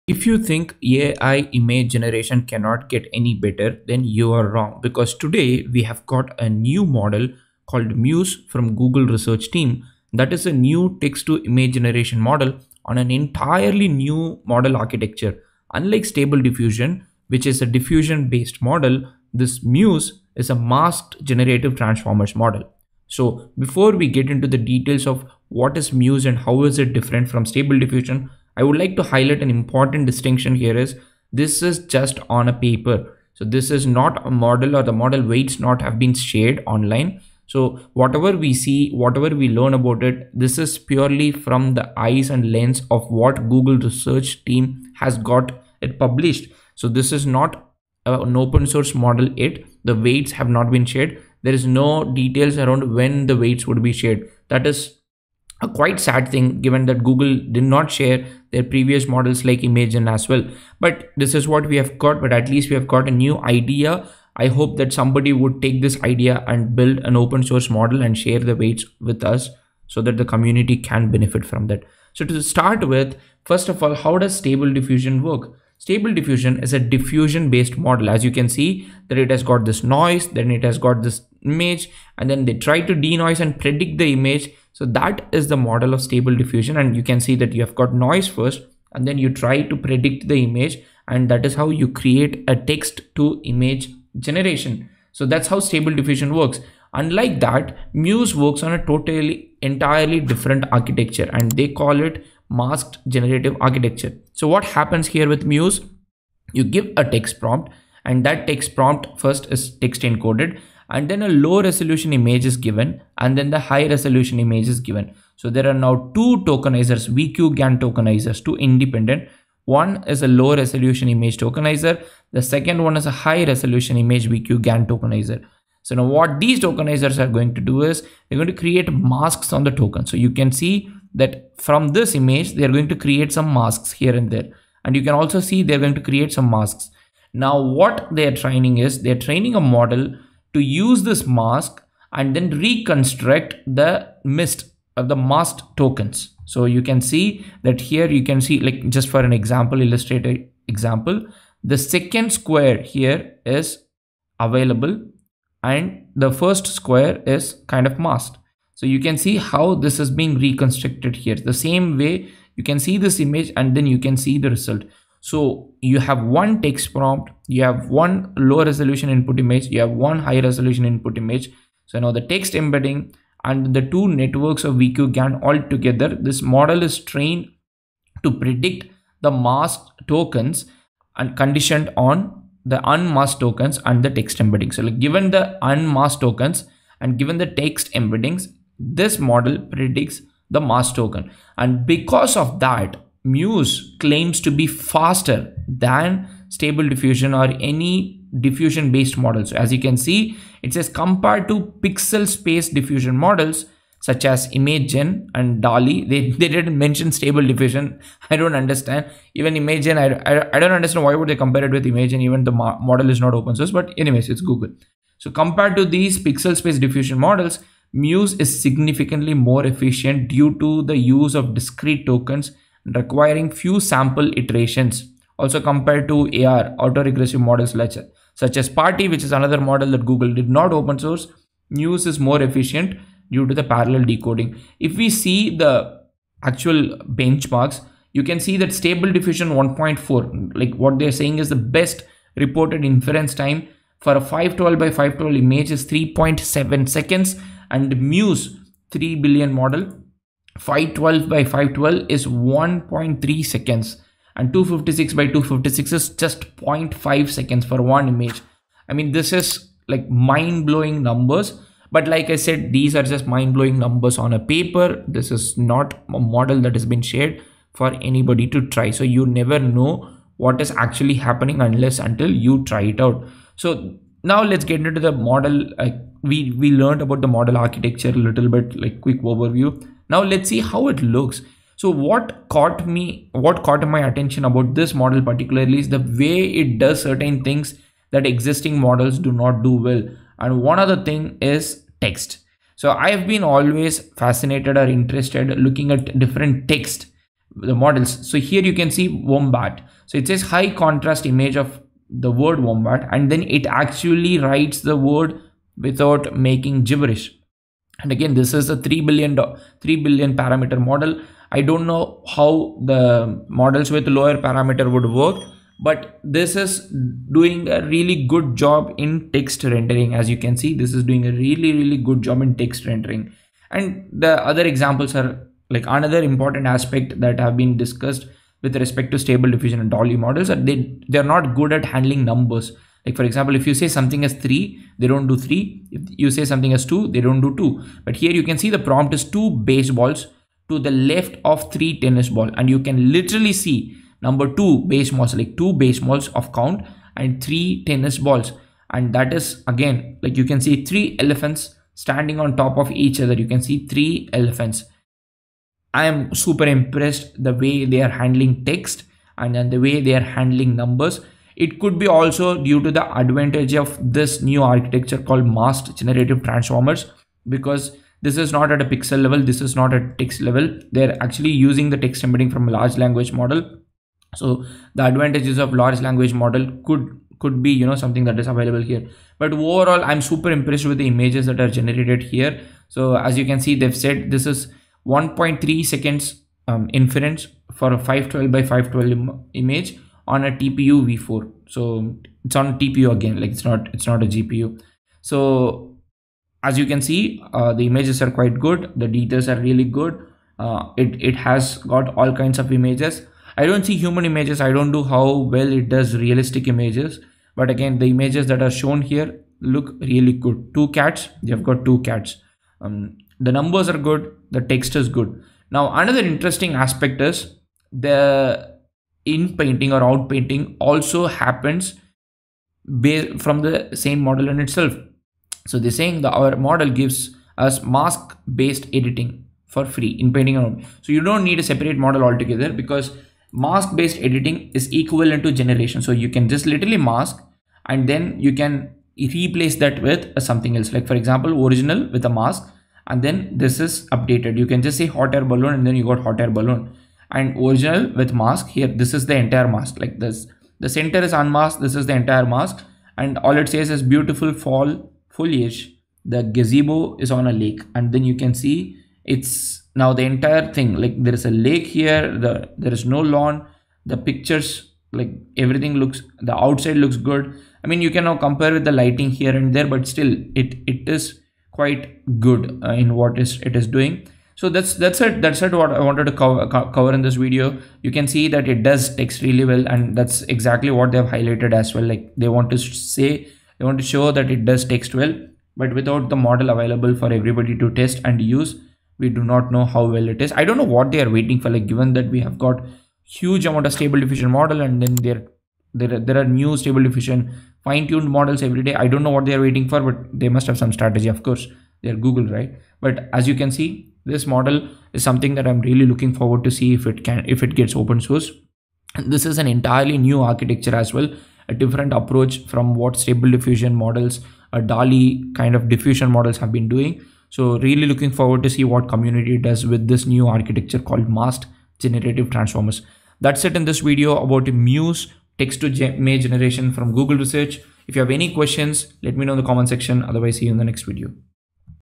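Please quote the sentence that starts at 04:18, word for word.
I mean, this is like mind blowing numbers.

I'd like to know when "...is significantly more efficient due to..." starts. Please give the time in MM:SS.
03:38.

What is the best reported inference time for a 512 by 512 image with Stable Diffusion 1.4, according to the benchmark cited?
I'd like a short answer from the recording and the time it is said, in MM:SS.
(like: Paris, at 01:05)
3.7 seconds, at 04:05.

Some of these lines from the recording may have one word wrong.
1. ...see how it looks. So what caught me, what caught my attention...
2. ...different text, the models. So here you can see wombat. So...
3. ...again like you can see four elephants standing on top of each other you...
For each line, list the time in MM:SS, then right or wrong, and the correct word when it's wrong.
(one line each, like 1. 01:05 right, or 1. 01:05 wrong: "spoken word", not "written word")
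1. 04:40 right
2. 04:56 right
3. 05:49 wrong: "three", not "four".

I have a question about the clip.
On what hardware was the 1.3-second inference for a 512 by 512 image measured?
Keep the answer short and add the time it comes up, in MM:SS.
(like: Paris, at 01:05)
TPU v4, at 06:30.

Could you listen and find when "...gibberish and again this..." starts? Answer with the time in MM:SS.
05:06.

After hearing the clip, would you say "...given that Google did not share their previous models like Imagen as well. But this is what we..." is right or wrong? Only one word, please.
right.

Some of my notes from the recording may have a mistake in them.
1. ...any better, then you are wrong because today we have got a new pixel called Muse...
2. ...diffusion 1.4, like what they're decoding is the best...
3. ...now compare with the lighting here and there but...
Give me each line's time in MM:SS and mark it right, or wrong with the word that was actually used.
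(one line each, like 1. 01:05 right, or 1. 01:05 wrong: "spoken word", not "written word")
1. 00:03 wrong: "model", not "pixel"
2. 03:59 wrong: "saying", not "decoding"
3. 07:48 right.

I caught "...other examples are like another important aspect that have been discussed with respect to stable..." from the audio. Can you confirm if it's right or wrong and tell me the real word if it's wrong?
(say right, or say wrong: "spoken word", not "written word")
right.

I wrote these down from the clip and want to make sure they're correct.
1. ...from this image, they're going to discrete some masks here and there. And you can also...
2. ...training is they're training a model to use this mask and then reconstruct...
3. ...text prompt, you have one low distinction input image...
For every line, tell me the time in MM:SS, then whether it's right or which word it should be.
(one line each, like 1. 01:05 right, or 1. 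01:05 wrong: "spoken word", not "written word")
1. 02:11 wrong: "create", not "discrete"
2. 02:18 right
3. 02:46 wrong: "resolution", not "distinction".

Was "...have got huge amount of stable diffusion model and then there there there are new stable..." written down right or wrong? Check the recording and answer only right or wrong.
right.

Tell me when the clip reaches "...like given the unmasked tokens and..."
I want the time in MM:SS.
03:04.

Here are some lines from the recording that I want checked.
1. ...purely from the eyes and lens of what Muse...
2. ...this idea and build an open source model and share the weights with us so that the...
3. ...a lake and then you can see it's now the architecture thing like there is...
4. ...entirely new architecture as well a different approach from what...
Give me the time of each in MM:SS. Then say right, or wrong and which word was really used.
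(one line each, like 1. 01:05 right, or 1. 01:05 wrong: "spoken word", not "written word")
1. 00:40 wrong: "Google", not "Muse"
2. 01:05 right
3. 07:37 wrong: "entire", not "architecture"
4. 08:29 right.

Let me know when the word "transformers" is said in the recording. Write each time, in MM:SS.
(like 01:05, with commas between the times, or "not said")
00:21, 06:06, 08:42.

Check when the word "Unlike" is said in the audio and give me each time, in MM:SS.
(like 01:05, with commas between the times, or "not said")
00:15, 01:36.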